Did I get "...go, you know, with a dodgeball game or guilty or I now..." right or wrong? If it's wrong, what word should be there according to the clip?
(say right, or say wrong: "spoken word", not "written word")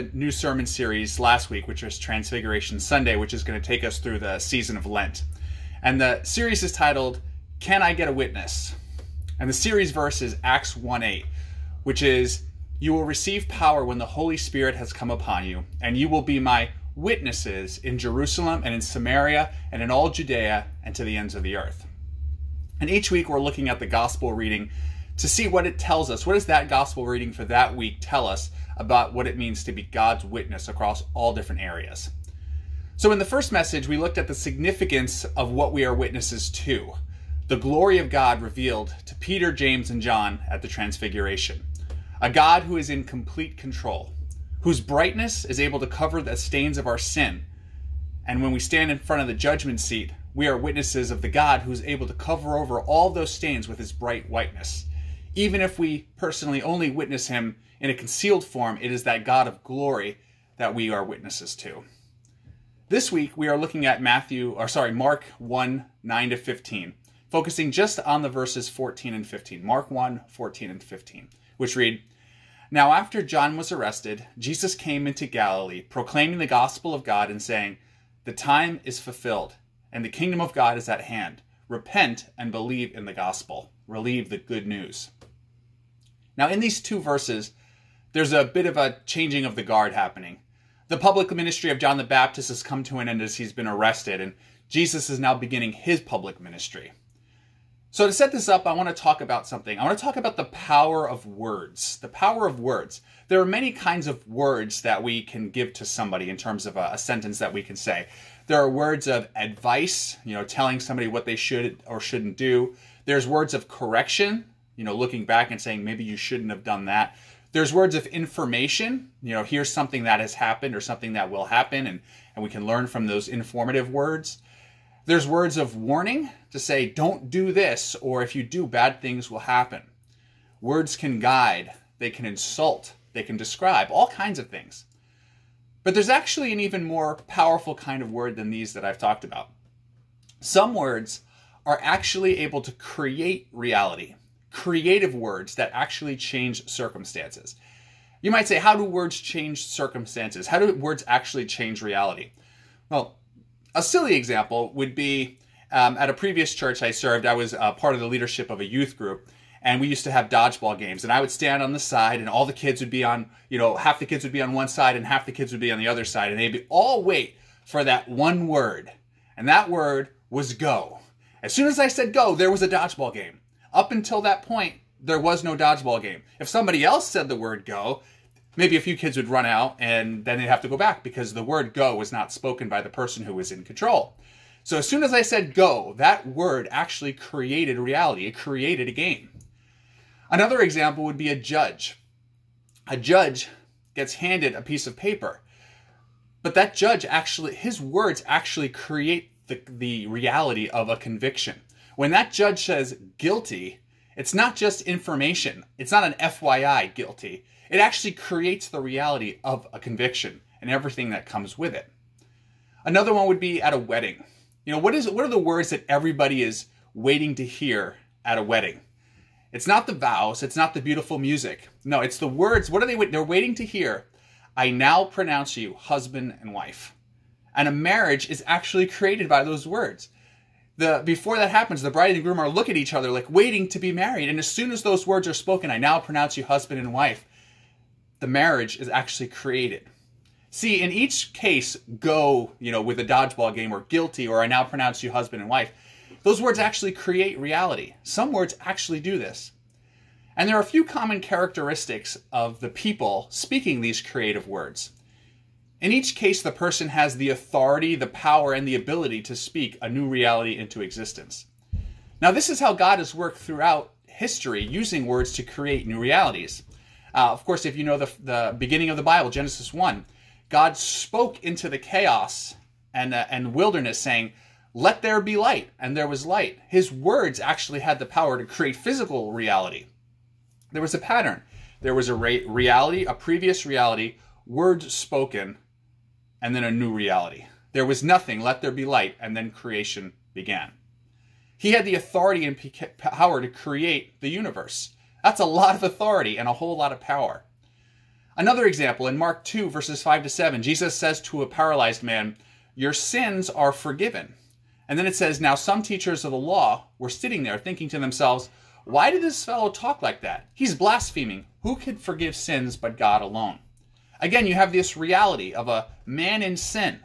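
right.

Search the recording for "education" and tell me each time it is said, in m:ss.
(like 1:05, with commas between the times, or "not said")
not said.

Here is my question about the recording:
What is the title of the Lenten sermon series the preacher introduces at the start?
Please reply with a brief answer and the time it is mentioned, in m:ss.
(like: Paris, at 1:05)
Can I Get a Witness?, at 0:07.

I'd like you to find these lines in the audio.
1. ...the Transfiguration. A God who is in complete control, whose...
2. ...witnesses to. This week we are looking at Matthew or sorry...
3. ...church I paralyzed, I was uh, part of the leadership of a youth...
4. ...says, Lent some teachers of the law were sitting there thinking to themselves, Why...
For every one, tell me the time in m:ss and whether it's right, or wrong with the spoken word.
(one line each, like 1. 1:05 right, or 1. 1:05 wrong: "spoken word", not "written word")
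1. 0:40 right
2. 1:01 right
3. 2:36 wrong: "served", not "paralyzed"
4. 5:05 wrong: "Now", not "Lent".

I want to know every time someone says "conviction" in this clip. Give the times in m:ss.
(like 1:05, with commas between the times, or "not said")
3:20, 3:29.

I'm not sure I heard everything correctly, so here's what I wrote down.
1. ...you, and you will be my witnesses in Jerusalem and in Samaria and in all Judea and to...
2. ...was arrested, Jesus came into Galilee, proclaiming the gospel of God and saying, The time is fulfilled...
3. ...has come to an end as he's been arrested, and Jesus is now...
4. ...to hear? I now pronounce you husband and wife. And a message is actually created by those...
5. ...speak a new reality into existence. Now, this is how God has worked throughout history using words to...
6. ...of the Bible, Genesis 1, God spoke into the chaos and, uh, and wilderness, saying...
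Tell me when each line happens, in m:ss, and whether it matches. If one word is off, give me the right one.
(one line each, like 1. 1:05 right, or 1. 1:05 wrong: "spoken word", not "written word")
1. 0:15 right
2. 1:13 right
3. 1:32 right
4. 3:43 wrong: "marriage", not "message"
5. 4:19 right
6. 4:28 right.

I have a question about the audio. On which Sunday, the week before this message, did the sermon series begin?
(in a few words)
Transfiguration Sunday.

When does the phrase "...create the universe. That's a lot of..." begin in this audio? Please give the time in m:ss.
4:53.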